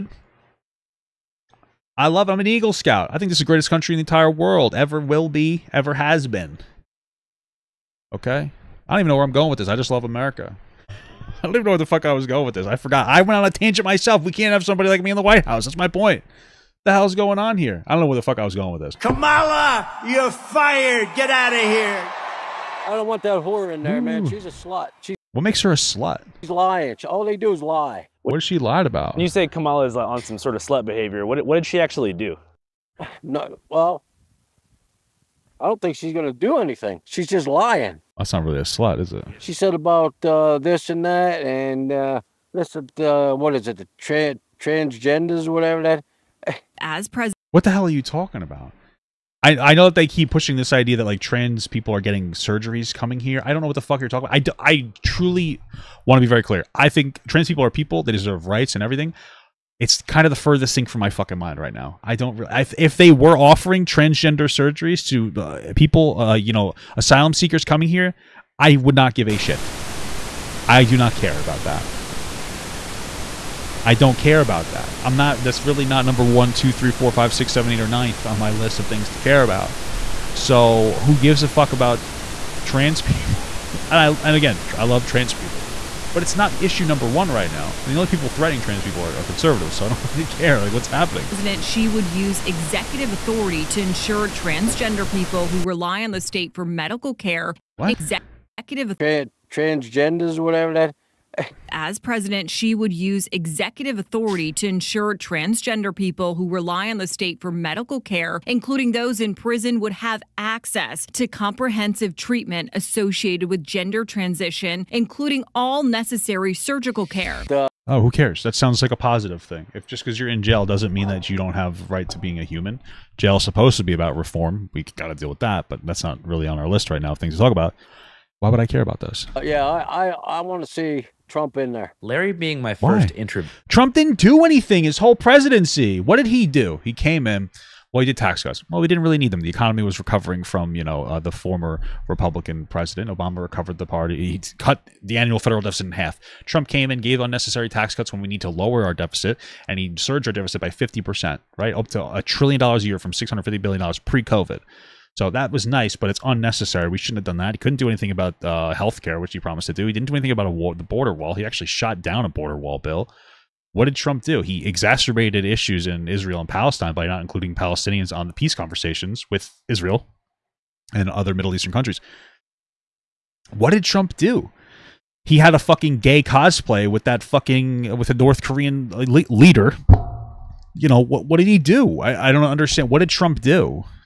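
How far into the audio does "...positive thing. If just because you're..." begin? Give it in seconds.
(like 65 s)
118 s.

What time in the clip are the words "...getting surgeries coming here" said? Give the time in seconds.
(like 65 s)
51 s.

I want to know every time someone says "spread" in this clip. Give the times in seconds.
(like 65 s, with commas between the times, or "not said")
not said.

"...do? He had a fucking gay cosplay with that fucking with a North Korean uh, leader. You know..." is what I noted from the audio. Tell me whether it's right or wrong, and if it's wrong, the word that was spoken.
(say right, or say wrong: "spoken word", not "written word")
right.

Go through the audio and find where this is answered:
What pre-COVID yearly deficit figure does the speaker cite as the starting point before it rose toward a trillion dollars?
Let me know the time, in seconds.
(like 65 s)
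153 s.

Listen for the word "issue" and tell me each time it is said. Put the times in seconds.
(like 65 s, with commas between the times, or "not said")
86 s, 165 s.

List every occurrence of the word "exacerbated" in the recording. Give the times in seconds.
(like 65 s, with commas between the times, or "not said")
164 s.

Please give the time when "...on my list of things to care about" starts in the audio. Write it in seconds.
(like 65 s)
78 s.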